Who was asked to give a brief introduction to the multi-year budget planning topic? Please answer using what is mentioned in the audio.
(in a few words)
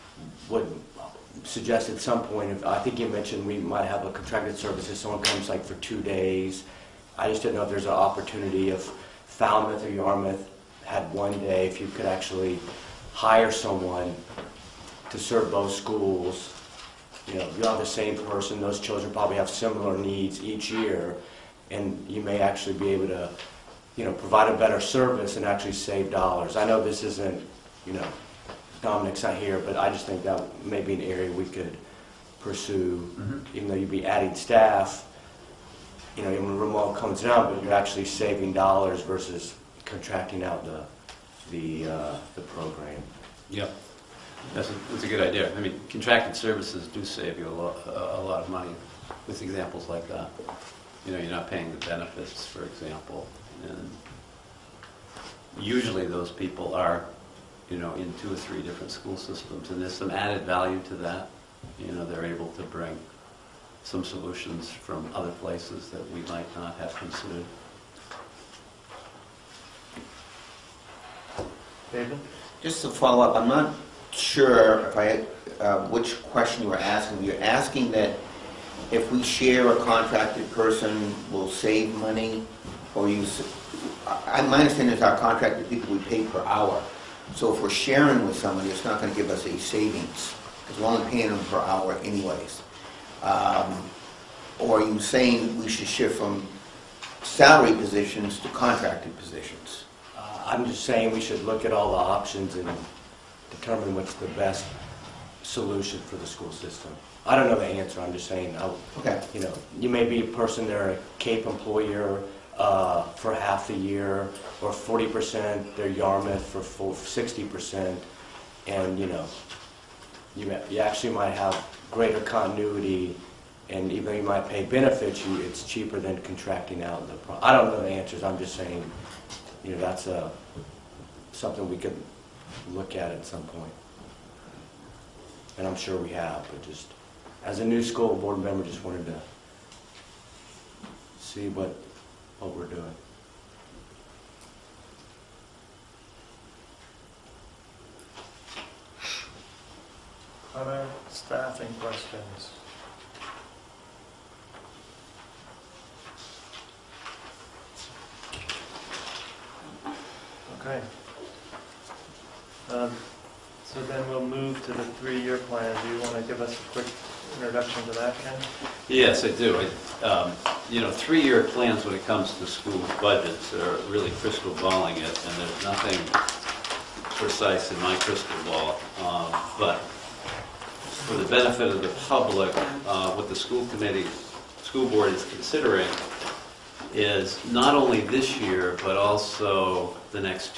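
Ken.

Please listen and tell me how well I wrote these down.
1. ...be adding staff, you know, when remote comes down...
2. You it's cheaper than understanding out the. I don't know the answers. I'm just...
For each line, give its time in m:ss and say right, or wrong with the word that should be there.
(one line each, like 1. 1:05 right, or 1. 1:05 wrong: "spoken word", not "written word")
1. 0:34 right
2. 2:05 wrong: "contracting", not "understanding".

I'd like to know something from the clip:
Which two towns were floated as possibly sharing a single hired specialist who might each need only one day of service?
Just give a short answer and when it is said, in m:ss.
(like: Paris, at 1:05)
Falmouth or Yarmouth, at 0:09.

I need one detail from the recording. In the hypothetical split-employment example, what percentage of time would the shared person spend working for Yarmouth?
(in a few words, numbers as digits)
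60 percent.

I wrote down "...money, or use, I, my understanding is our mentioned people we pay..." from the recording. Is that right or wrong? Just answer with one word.
wrong.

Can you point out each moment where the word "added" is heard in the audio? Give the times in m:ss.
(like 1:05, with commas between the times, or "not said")
1:00.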